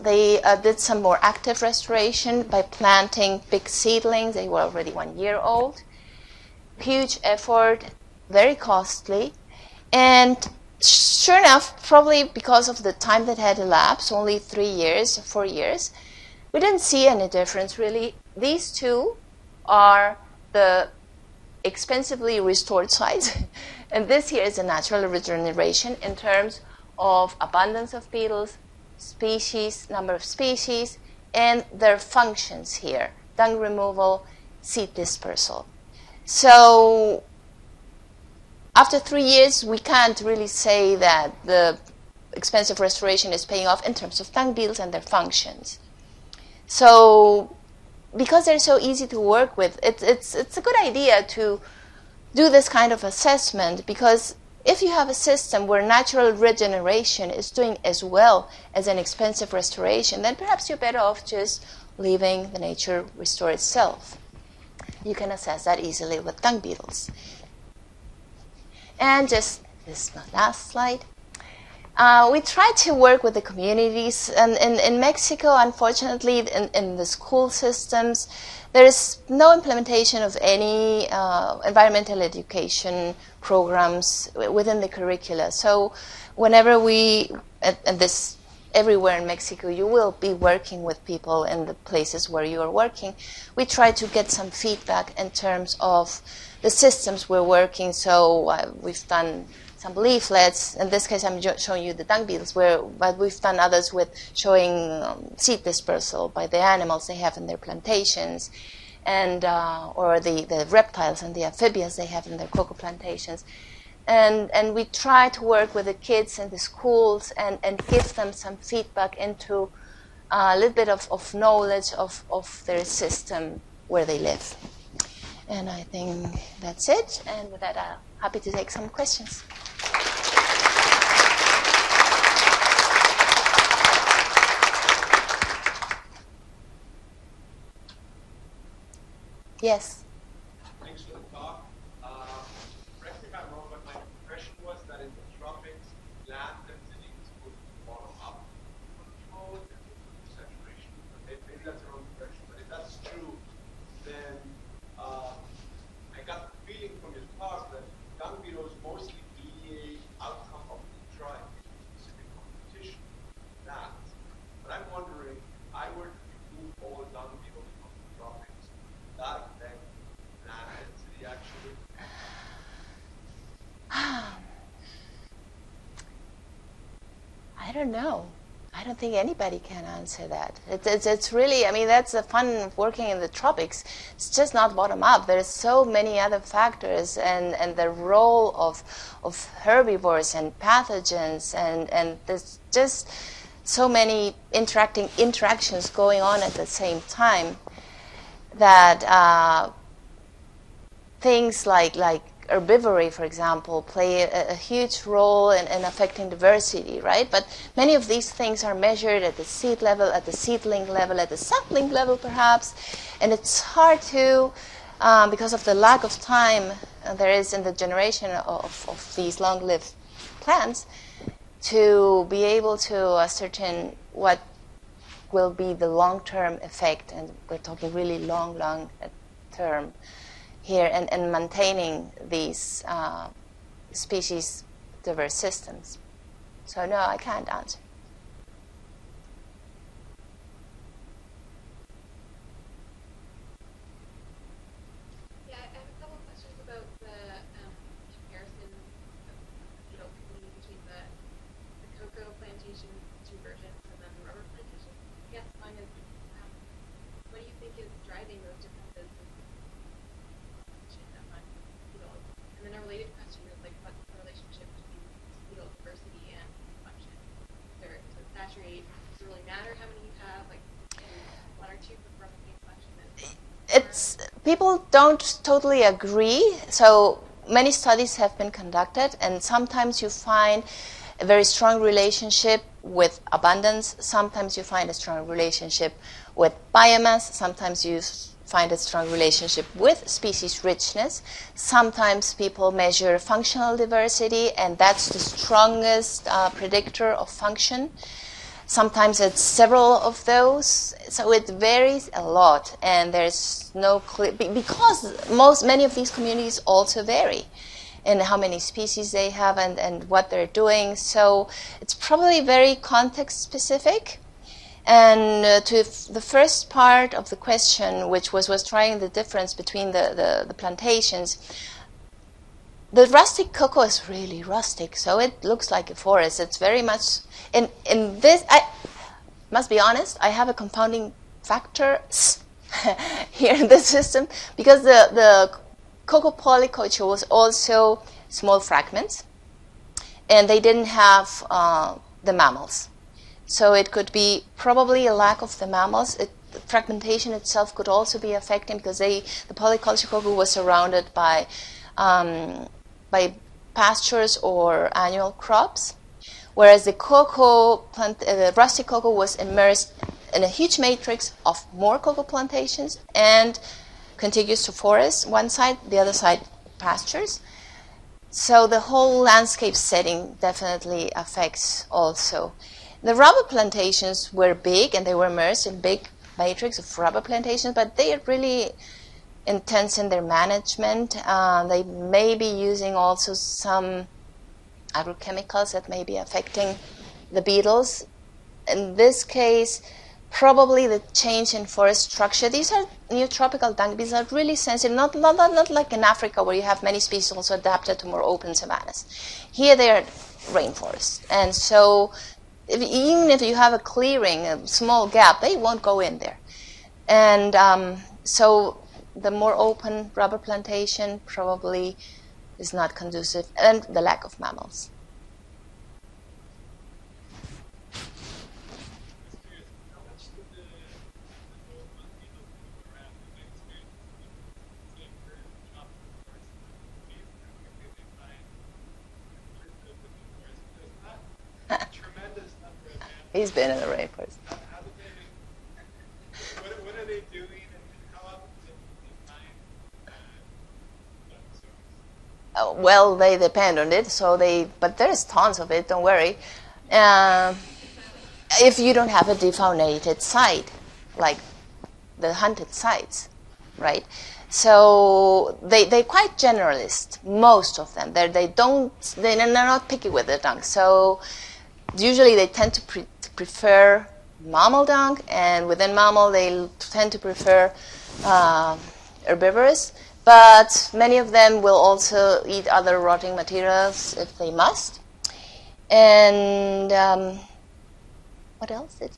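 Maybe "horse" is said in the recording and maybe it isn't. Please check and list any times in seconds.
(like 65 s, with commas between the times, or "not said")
not said.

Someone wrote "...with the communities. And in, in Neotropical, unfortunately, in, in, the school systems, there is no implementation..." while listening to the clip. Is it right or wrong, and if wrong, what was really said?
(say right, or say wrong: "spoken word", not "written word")
wrong: "Mexico", not "Neotropical".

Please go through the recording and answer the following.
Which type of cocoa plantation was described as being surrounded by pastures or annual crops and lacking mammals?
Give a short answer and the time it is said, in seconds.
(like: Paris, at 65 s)
Polyculture cocoa, at 349 s.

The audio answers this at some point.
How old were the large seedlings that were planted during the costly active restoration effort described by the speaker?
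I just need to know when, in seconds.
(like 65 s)
4 s.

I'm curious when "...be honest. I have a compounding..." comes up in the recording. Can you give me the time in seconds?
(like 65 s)
329 s.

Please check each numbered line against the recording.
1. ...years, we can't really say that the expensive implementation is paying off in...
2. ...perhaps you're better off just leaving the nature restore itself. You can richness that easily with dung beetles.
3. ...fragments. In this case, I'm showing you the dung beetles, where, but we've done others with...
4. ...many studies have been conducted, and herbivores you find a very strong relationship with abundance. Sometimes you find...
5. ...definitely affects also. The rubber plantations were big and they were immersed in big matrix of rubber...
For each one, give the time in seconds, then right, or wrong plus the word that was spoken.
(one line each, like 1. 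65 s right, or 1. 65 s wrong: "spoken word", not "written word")
1. 39 s wrong: "restoration", not "implementation"
2. 60 s wrong: "assess", not "richness"
3. 99 s wrong: "leaflets", not "fragments"
4. 277 s wrong: "sometimes", not "herbivores"
5. 370 s right.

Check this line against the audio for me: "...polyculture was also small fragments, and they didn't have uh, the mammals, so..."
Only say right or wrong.
right.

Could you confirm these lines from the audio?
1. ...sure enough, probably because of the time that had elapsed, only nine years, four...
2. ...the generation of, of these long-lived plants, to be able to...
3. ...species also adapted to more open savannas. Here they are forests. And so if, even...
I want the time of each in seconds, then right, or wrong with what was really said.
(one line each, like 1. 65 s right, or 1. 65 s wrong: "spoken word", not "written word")
1. 10 s wrong: "three", not "nine"
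2. 217 s right
3. 396 s wrong: "rainforests", not "forests".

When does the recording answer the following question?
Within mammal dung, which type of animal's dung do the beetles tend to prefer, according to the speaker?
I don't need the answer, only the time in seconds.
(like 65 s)
469 s.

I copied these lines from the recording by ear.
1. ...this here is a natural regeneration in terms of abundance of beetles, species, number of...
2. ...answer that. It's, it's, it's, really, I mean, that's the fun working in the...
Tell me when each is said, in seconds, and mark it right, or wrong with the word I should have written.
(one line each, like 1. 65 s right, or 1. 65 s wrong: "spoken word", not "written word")
1. 24 s right
2. 179 s right.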